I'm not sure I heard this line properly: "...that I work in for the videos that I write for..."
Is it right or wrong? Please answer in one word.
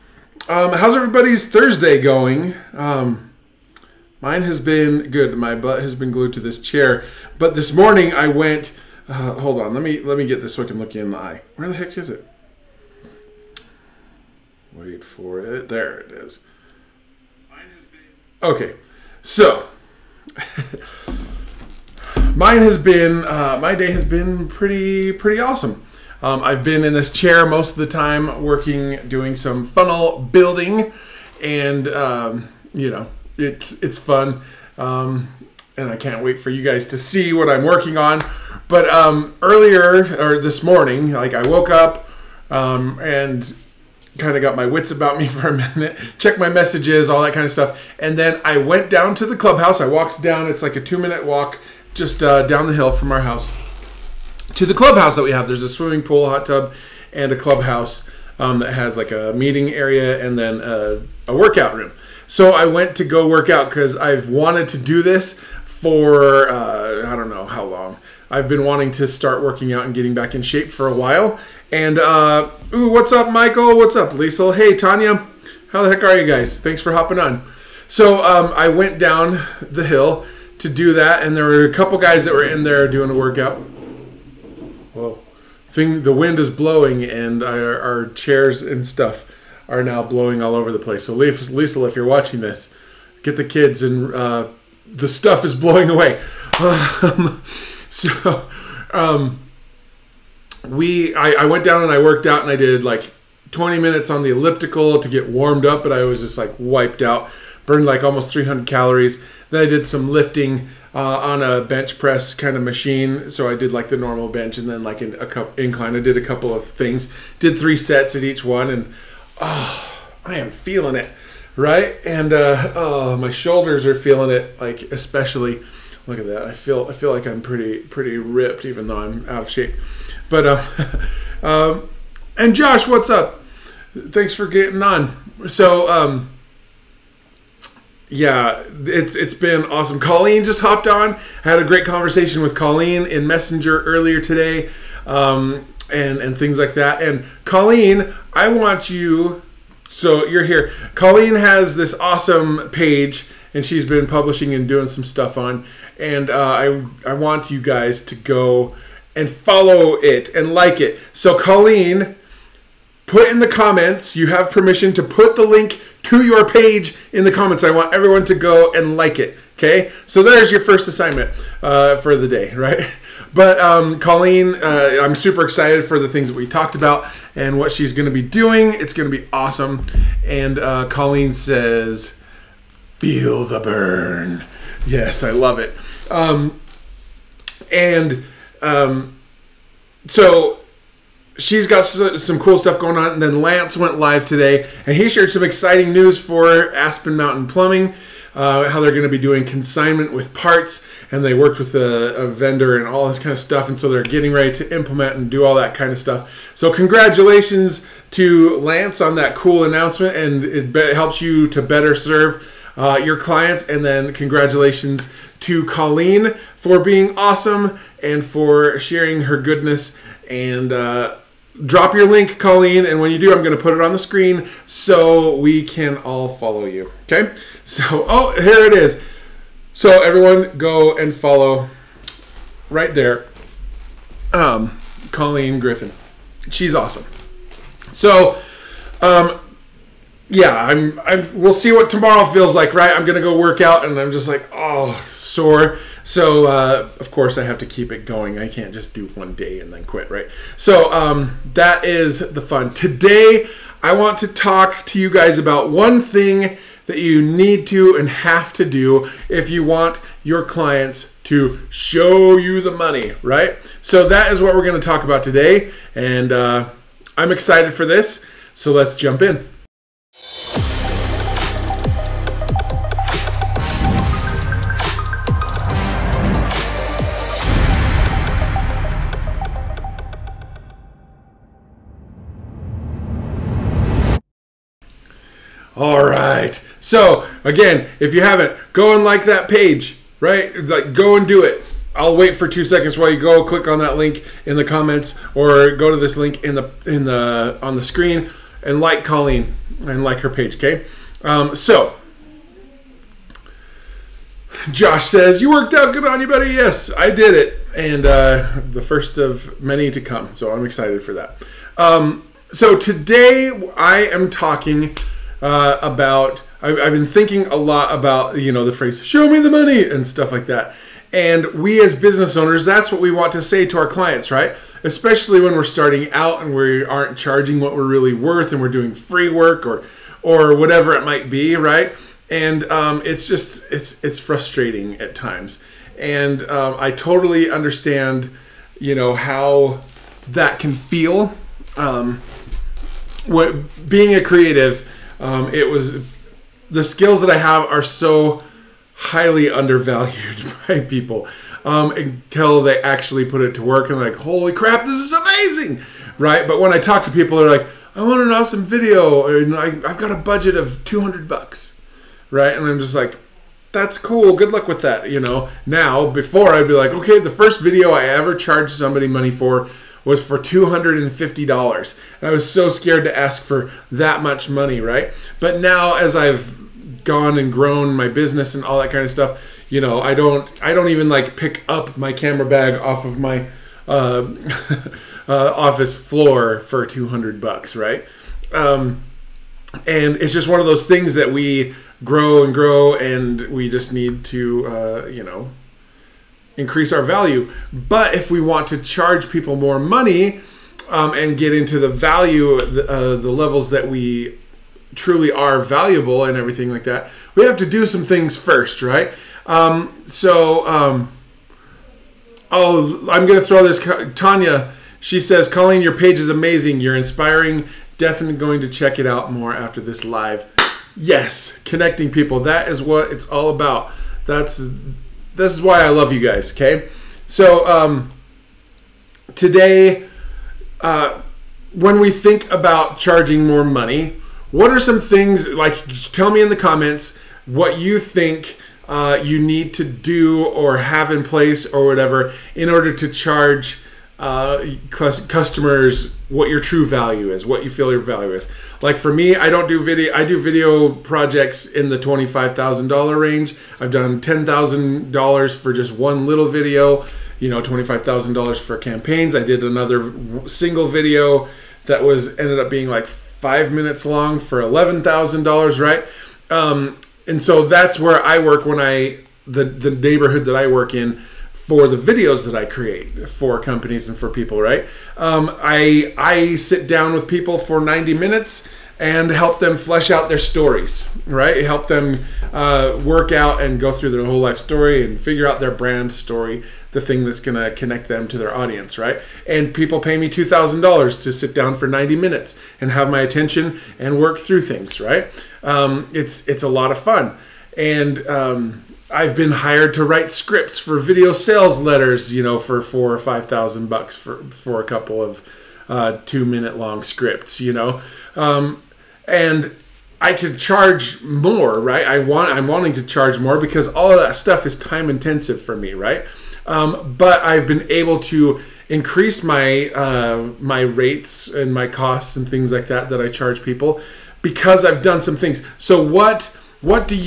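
wrong.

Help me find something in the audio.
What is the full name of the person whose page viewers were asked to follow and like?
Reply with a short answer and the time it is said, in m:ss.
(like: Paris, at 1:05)
Colleen Griffin, at 3:55.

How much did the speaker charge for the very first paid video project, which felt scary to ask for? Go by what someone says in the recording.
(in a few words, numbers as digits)
$250.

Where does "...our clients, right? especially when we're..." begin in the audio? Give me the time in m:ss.
5:23.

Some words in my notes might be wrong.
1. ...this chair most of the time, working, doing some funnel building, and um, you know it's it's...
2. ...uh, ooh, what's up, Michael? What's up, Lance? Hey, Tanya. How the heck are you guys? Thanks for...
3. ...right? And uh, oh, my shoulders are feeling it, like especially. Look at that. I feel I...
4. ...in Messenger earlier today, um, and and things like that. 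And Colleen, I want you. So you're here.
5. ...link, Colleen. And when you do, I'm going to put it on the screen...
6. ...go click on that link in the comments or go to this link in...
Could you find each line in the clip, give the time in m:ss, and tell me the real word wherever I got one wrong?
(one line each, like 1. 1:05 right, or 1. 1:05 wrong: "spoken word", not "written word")
1. 0:26 right
2. 1:11 wrong: "Lisa", not "Lance"
3. 2:01 right
4. 2:23 right
5. 3:42 right
6. 4:53 right.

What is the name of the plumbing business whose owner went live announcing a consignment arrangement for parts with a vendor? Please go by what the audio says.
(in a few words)
Aspen Mountain Plumbing.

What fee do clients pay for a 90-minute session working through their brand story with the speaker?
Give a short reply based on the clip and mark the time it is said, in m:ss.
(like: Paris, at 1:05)
$2,000, at 8:10.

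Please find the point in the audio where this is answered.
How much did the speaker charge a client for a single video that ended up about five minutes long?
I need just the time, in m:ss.
7:44.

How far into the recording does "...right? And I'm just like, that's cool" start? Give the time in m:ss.
6:02.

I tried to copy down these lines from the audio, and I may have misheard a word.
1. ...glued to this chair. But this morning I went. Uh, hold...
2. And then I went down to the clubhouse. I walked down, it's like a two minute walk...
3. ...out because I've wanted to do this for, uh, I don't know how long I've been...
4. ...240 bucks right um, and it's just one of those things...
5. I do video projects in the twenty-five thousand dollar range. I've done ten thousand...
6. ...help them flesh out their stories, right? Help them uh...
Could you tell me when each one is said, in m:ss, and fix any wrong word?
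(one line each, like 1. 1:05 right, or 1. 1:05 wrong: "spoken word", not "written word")
1. 0:06 right
2. 0:47 right
3. 1:03 right
4. 6:26 wrong: "200", not "240"
5. 7:30 right
6. 7:59 right.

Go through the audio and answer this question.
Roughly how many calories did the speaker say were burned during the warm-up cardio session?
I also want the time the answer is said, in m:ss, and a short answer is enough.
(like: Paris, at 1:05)
almost 300, at 1:48.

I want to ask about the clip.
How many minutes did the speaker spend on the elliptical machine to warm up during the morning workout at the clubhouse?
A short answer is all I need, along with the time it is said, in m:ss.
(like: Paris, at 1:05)
20, at 1:43.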